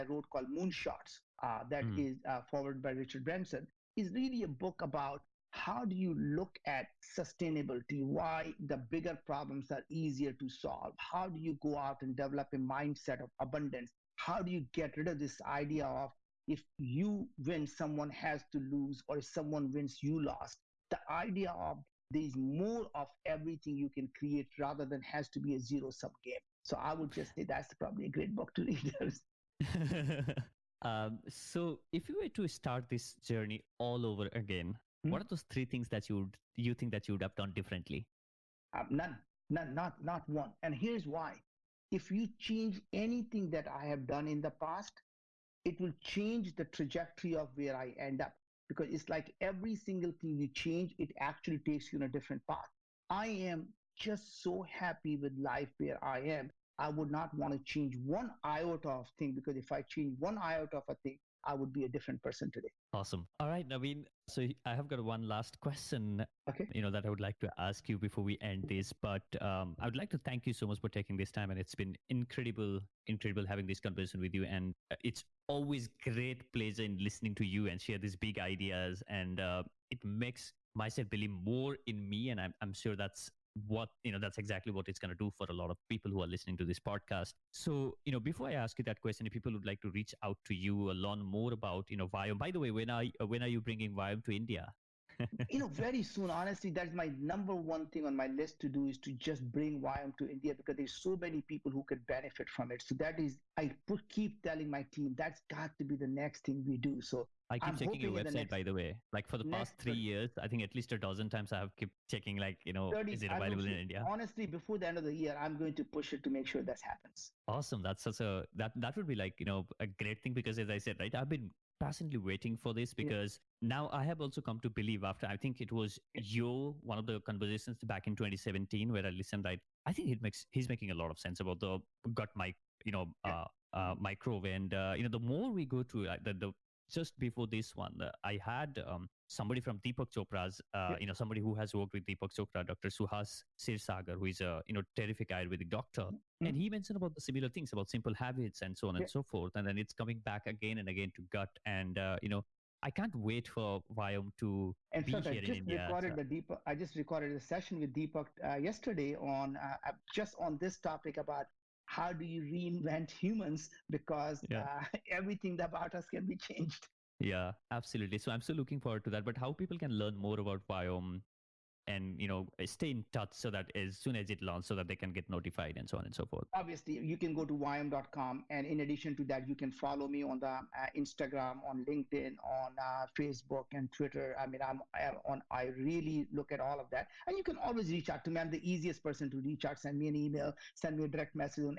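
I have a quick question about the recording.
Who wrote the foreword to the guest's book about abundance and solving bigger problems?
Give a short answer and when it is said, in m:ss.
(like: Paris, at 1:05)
Richard Branson, at 0:02.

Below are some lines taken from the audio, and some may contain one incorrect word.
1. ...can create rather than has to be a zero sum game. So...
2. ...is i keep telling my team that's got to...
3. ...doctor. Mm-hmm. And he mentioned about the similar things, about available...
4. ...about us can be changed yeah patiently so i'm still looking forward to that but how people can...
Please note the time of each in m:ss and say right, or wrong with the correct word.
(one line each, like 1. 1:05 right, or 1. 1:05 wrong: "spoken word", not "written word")
1. 0:23 right
2. 1:43 right
3. 2:25 wrong: "simple", not "available"
4. 2:45 wrong: "absolutely", not "patiently".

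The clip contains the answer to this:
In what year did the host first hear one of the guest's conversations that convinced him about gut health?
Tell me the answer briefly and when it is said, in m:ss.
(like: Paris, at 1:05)
2017, at 2:08.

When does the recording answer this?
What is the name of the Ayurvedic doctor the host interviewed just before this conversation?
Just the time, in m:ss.
2:22.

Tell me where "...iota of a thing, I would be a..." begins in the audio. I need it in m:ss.
1:00.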